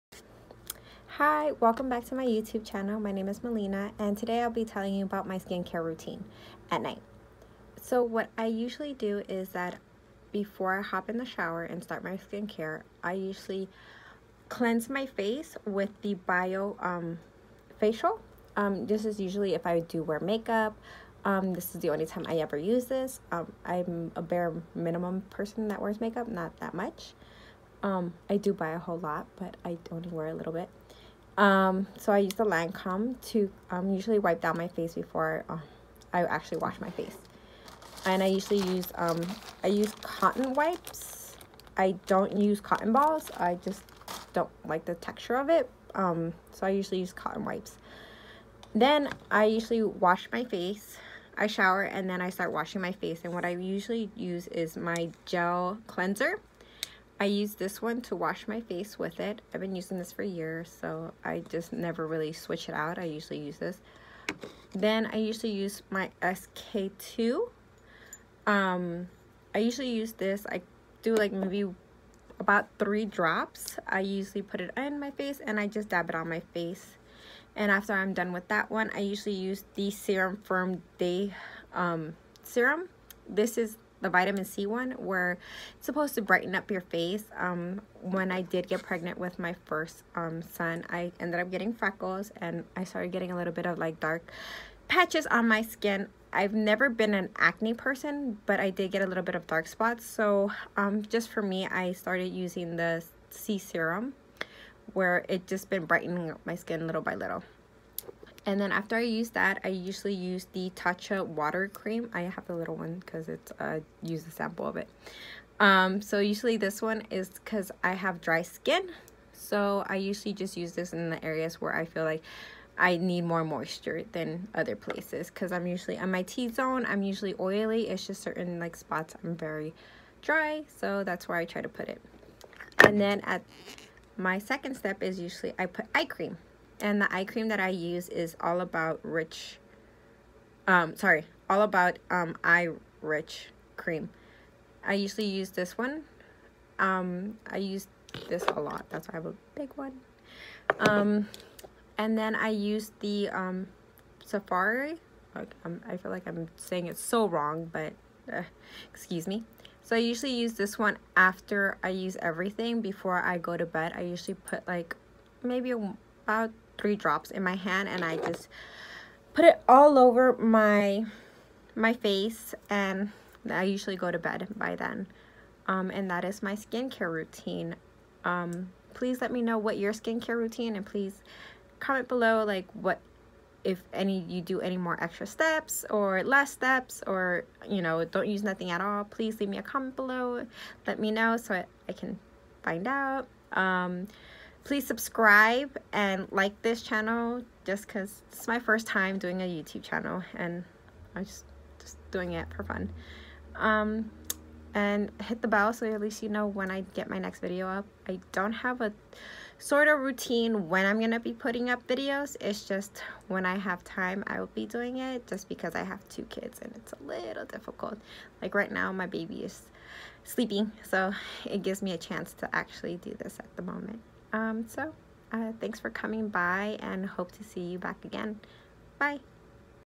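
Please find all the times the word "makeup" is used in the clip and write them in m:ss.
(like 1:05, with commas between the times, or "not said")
0:20, 0:26.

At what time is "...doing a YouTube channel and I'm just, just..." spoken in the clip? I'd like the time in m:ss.
3:19.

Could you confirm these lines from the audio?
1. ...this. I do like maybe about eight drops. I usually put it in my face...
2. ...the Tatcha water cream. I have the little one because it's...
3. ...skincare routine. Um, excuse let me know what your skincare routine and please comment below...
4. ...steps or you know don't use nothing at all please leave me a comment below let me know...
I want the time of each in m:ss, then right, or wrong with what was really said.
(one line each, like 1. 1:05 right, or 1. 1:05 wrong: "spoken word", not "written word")
1. 1:10 wrong: "three", not "eight"
2. 1:50 right
3. 2:56 wrong: "please", not "excuse"
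4. 3:06 right.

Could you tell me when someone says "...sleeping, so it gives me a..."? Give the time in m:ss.
3:40.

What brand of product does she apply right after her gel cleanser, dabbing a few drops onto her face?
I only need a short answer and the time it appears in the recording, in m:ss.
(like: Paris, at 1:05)
SK-II, at 1:06.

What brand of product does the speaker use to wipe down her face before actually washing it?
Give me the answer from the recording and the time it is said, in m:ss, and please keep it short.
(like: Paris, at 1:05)
Lancome, at 0:32.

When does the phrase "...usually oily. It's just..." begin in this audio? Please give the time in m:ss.
2:07.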